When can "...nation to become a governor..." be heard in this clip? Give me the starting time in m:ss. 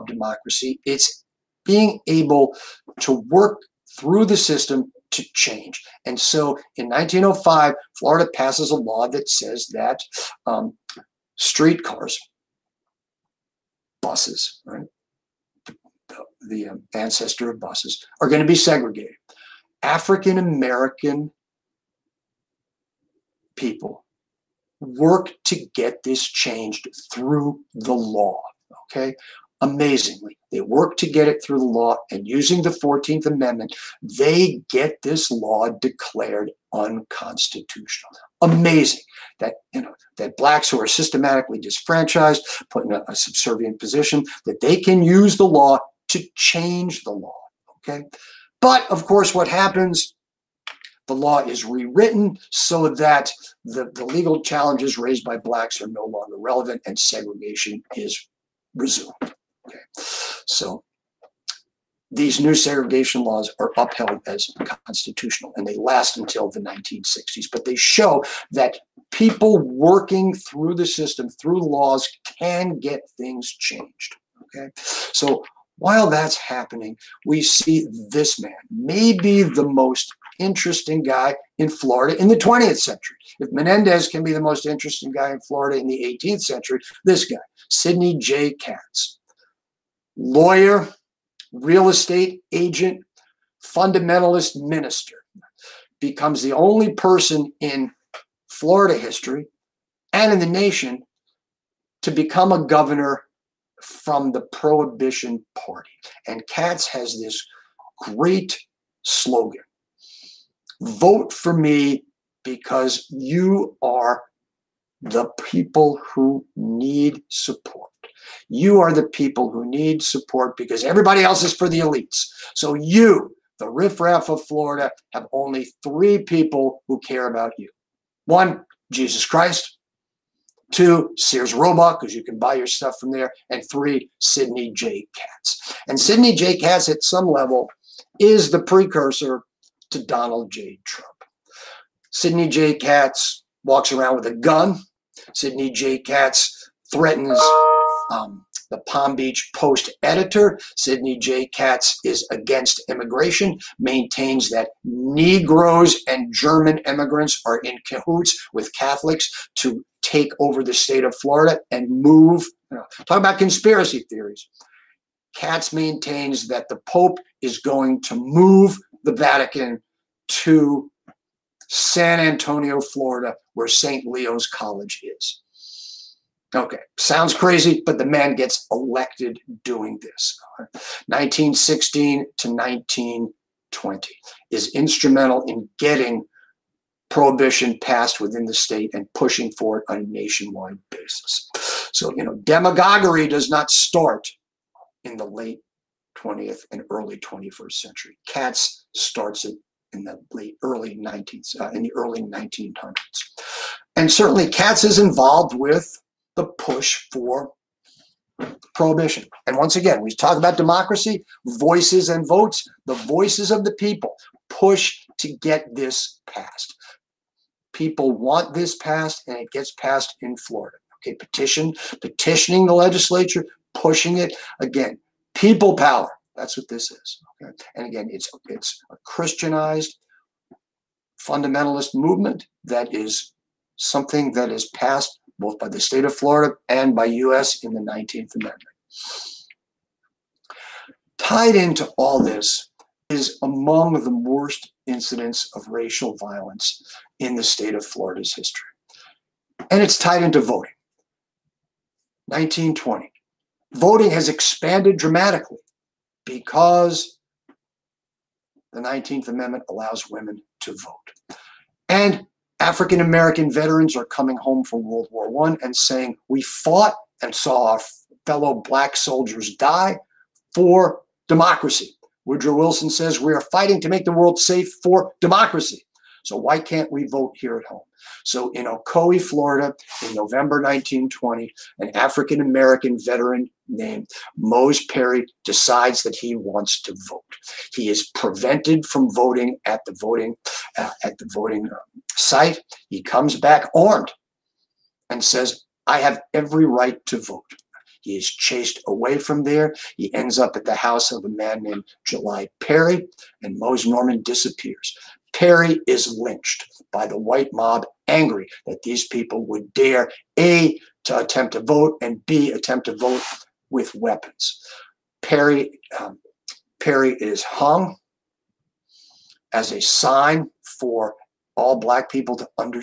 1:40.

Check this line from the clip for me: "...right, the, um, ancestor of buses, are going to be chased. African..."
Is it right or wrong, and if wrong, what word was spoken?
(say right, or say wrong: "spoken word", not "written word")
wrong: "segregated", not "chased".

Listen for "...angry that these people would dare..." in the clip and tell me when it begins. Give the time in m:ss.
5:08.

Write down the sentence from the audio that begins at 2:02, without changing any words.
So you, the riffraff of Florida, have only three people who care about you.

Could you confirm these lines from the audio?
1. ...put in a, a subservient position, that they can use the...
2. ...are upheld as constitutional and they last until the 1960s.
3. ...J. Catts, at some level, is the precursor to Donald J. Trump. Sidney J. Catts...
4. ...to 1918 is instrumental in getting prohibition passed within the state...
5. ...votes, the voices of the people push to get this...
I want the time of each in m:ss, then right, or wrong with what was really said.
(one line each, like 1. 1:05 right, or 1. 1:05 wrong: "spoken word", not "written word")
1. 0:42 right
2. 1:03 right
3. 2:16 right
4. 3:02 wrong: "1920", not "1918"
5. 3:32 right.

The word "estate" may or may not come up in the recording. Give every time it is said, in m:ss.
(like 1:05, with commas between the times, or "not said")
1:31.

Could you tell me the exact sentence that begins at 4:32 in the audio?
Woodrow Wilson says, We are fighting to make the world safe for democracy.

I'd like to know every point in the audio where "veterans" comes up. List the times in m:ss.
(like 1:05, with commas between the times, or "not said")
4:23, 4:43.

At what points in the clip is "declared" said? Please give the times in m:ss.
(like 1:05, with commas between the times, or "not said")
0:35.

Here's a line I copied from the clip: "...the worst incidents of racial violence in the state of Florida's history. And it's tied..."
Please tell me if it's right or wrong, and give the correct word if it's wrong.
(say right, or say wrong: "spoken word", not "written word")
right.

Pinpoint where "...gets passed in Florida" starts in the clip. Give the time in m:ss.
3:39.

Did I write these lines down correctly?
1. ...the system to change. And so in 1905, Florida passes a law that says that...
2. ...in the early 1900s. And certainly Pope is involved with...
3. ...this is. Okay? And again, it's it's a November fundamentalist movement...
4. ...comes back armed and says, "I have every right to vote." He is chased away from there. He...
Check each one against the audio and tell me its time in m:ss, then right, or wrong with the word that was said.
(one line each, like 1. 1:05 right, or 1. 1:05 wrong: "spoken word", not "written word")
1. 0:04 right
2. 3:21 wrong: "Catts", not "Pope"
3. 3:46 wrong: "Christianized", not "November"
4. 4:53 right.